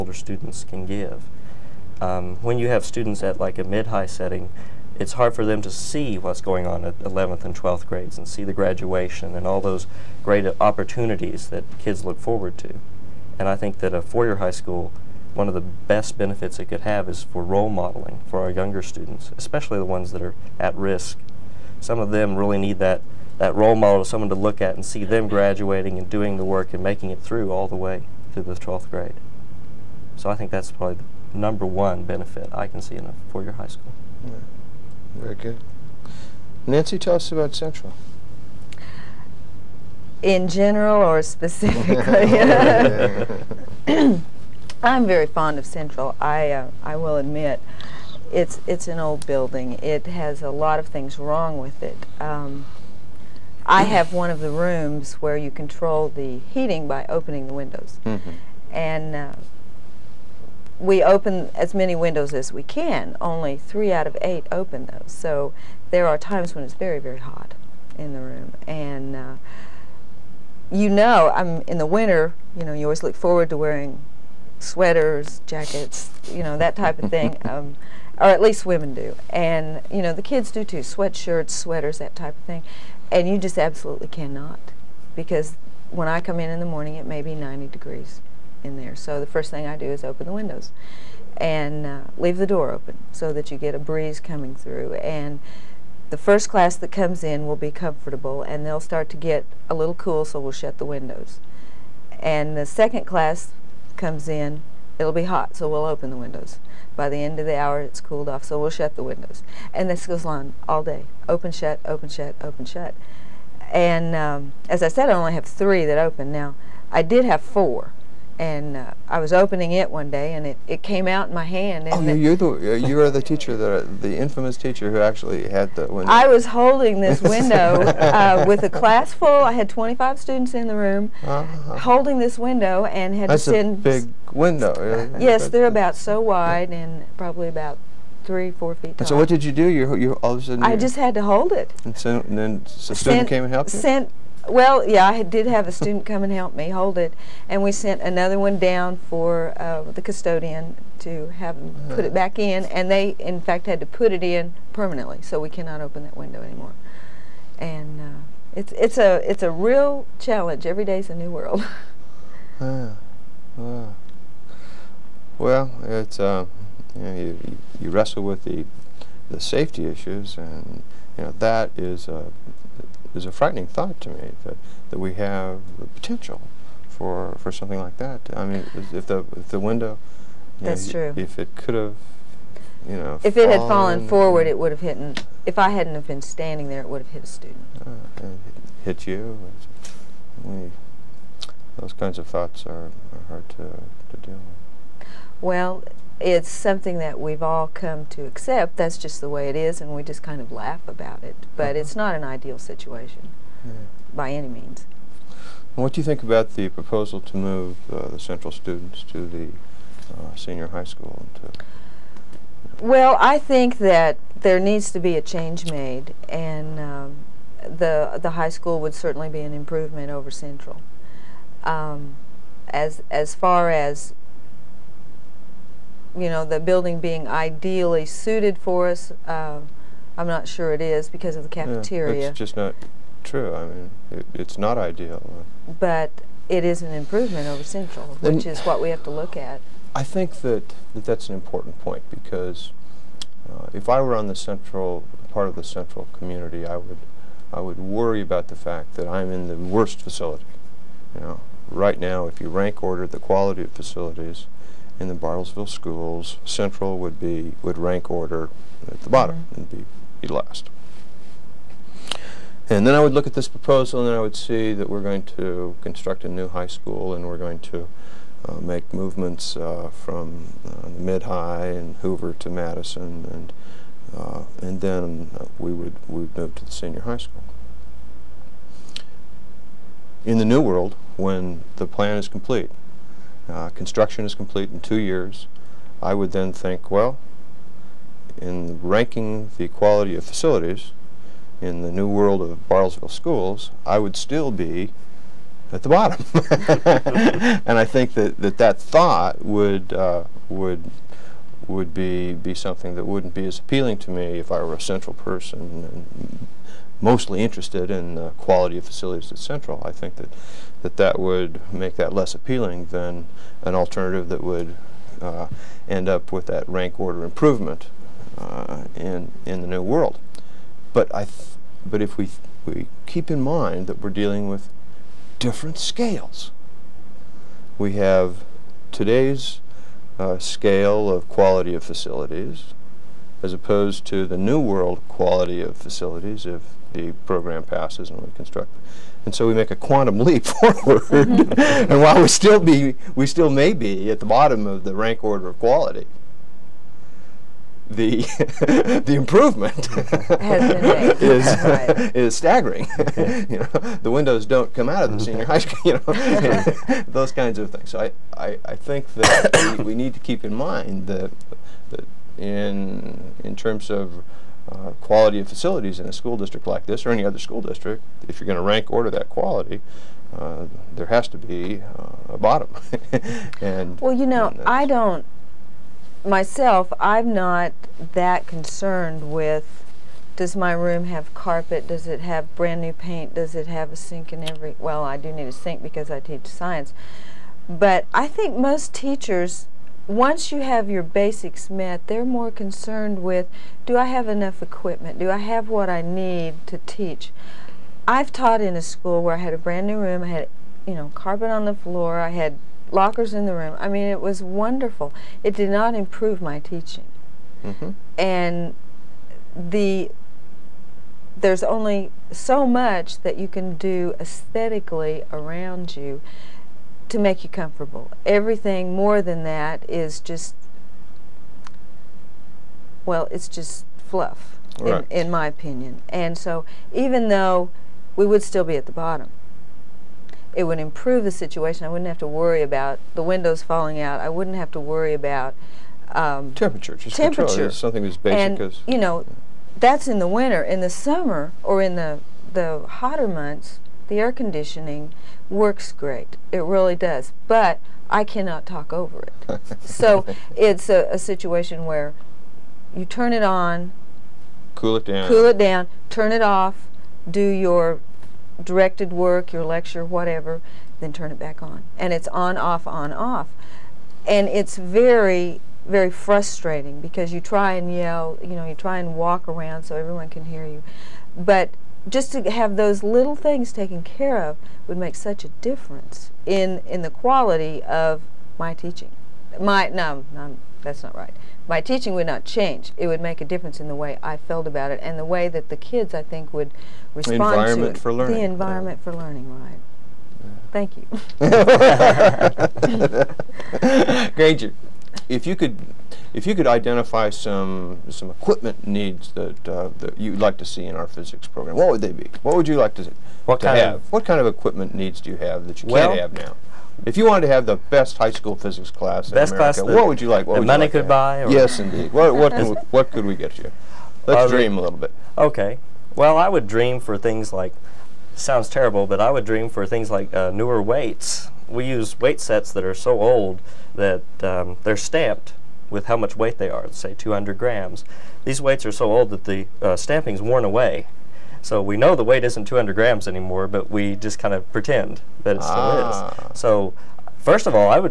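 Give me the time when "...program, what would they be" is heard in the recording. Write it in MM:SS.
08:21.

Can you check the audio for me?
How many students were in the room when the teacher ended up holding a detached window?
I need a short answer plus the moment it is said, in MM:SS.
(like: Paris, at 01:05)
25, at 02:09.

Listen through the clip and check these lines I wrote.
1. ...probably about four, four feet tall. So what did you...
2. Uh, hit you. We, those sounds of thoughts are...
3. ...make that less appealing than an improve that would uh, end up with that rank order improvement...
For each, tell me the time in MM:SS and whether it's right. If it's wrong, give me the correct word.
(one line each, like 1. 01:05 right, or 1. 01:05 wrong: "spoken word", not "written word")
1. 02:17 wrong: "three", not "four"
2. 03:07 wrong: "kinds", not "sounds"
3. 05:11 wrong: "alternative", not "improve".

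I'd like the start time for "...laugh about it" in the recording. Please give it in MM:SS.
03:20.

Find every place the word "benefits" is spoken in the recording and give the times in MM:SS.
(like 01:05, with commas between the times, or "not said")
00:16, 00:32.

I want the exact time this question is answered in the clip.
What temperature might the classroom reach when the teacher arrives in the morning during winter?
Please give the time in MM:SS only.
01:27.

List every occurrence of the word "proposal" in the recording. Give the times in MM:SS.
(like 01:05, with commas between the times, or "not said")
03:26, 04:23.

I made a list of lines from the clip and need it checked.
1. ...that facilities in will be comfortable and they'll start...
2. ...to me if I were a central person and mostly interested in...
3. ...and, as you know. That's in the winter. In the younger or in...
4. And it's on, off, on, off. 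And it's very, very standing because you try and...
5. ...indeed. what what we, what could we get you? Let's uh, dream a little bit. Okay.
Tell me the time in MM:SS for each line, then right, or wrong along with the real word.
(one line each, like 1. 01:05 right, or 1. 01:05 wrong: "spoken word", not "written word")
1. 01:36 wrong: "comes", not "facilities"
2. 05:03 right
3. 07:18 wrong: "summer", not "younger"
4. 07:41 wrong: "frustrating", not "standing"
5. 08:31 right.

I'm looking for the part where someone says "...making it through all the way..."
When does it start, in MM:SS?
00:26.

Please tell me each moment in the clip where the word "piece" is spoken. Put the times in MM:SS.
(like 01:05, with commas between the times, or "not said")
not said.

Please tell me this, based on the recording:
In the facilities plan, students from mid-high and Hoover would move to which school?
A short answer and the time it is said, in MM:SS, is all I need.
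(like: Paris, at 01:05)
Madison, at 04:32.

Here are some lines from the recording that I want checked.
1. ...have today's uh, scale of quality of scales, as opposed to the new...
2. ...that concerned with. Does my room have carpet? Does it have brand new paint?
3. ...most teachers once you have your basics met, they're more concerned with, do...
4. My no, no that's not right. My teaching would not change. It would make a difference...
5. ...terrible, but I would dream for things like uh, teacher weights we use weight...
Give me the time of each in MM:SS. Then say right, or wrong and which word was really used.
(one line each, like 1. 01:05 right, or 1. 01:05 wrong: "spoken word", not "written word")
1. 05:27 wrong: "facilities", not "scales"
2. 06:18 right
3. 06:28 right
4. 07:59 right
5. 08:38 wrong: "newer", not "teacher".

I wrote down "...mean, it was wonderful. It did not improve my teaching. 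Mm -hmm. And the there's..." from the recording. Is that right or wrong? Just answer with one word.
right.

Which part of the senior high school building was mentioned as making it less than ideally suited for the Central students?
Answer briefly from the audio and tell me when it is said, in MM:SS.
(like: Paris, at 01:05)
the cafeteria, at 03:51.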